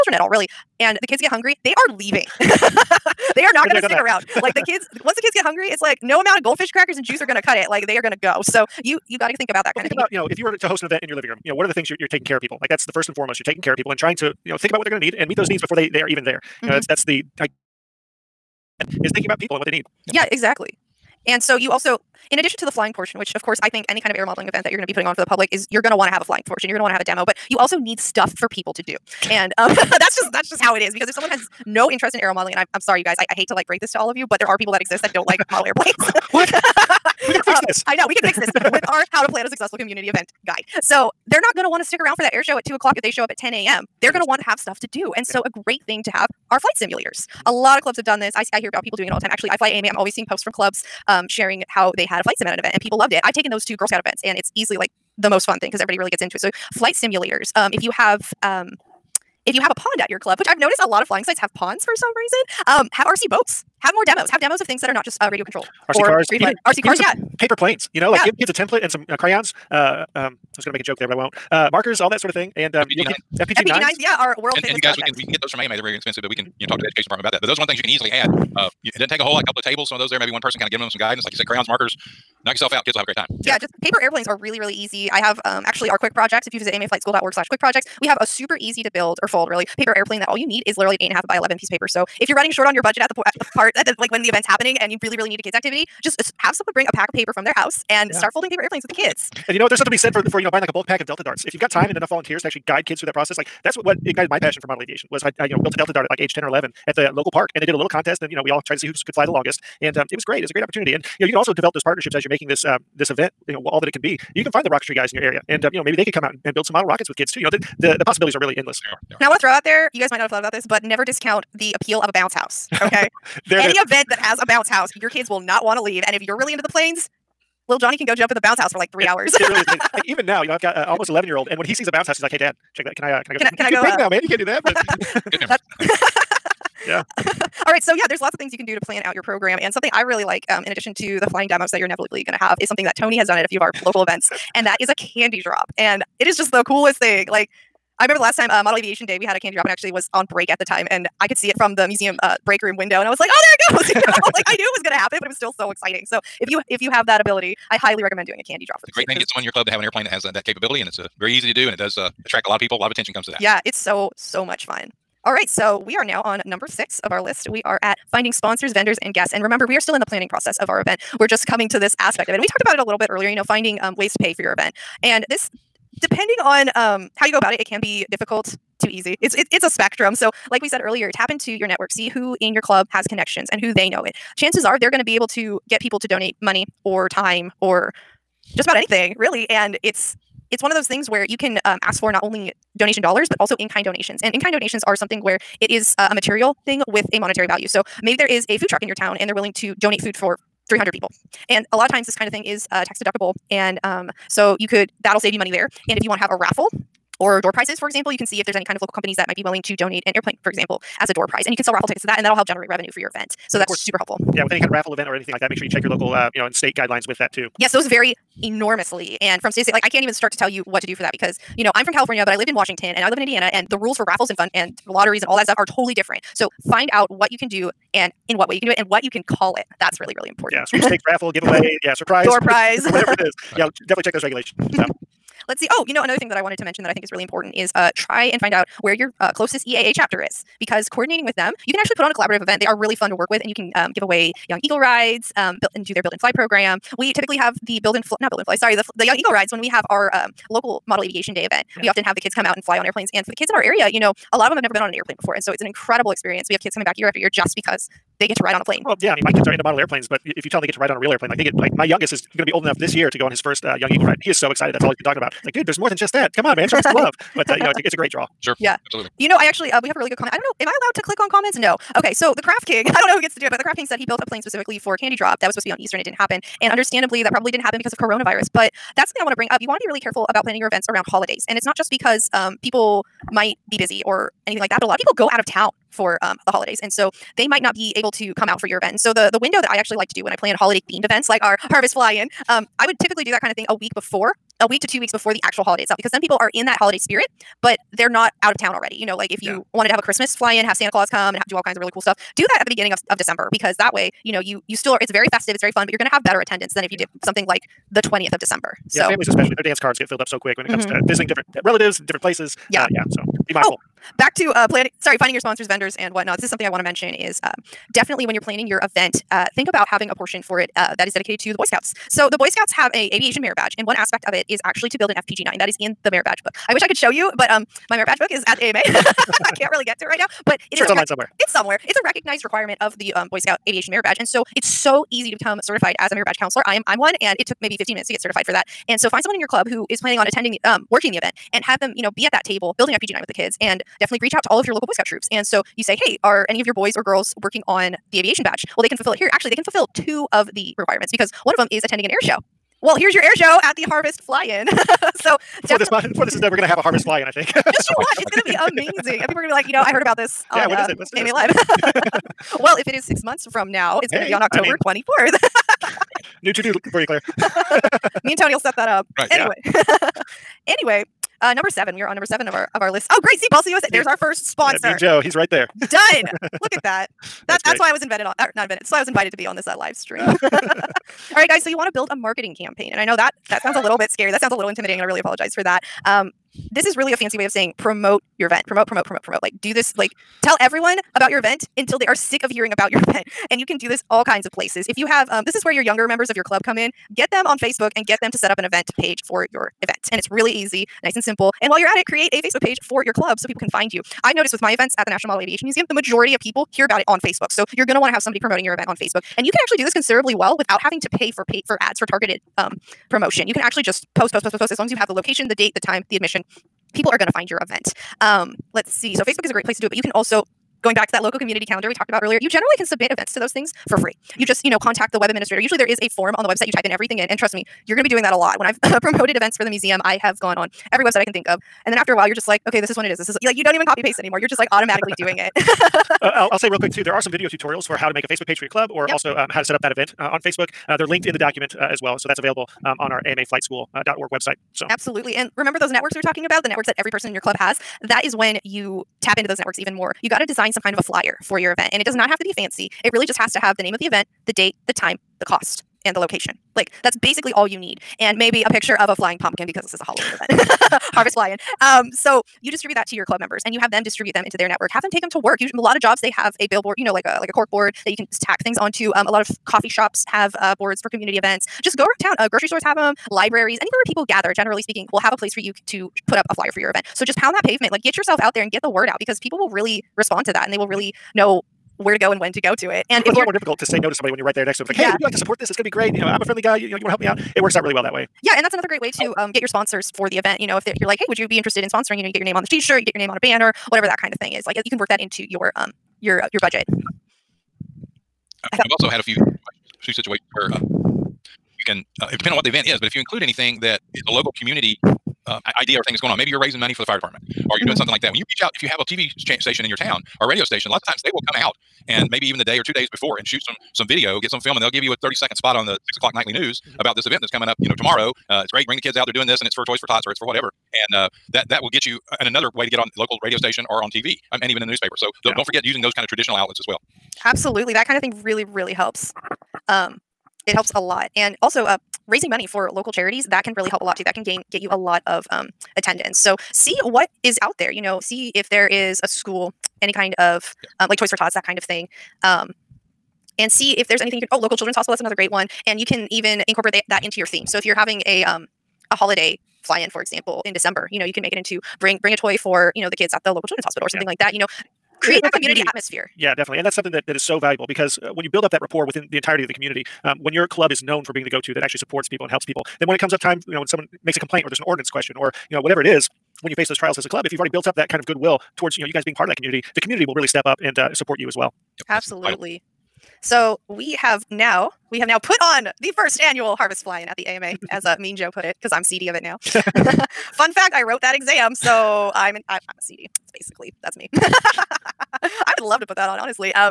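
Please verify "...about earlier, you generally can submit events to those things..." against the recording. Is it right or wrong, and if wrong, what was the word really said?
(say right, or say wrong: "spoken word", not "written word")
right.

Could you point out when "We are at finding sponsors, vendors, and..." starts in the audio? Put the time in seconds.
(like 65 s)
167 s.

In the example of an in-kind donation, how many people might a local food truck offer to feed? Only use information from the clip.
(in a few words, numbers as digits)
300.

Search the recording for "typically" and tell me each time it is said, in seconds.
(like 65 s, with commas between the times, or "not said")
247 s, 292 s.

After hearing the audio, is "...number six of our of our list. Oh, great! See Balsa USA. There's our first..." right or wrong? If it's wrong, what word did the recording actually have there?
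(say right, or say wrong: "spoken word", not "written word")
wrong: "seven", not "six".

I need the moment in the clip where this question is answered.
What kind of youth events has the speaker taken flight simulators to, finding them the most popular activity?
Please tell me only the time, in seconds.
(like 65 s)
53 s.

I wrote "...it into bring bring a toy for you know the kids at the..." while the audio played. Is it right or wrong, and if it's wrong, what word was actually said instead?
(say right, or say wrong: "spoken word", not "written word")
right.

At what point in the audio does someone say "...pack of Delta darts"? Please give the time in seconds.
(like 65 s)
100 s.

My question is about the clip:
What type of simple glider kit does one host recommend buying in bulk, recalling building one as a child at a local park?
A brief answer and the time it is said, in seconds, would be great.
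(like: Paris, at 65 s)
Delta dart, at 105 s.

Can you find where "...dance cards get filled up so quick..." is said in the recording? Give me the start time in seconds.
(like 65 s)
309 s.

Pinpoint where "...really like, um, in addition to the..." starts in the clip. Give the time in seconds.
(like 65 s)
140 s.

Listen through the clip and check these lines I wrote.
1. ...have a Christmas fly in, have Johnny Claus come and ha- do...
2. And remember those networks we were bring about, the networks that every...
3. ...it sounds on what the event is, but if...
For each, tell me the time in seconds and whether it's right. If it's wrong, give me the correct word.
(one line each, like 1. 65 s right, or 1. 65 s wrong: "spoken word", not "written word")
1. 299 s wrong: "Santa", not "Johnny"
2. 445 s wrong: "talking", not "bring"
3. 502 s wrong: "depends", not "sounds".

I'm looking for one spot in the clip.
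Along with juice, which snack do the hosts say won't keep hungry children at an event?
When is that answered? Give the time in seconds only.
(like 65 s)
6 s.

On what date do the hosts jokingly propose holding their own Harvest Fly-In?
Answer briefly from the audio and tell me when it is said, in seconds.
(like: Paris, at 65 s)
October 24th, at 364 s.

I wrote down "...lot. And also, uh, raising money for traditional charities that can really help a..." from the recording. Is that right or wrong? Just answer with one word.
wrong.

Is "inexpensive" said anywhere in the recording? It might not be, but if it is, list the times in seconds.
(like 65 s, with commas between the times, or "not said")
75 s.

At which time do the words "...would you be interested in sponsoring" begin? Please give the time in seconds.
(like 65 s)
491 s.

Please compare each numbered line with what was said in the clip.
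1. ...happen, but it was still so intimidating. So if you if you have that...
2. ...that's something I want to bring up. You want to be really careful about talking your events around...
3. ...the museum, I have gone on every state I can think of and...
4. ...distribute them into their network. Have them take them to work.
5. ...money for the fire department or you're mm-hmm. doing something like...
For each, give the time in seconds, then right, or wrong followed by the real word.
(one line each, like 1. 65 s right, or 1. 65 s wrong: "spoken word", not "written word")
1. 154 s wrong: "exciting", not "intimidating"
2. 278 s wrong: "planning", not "talking"
3. 429 s wrong: "website", not "state"
4. 464 s right
5. 506 s right.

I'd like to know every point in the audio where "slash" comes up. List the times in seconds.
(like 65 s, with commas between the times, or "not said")
87 s.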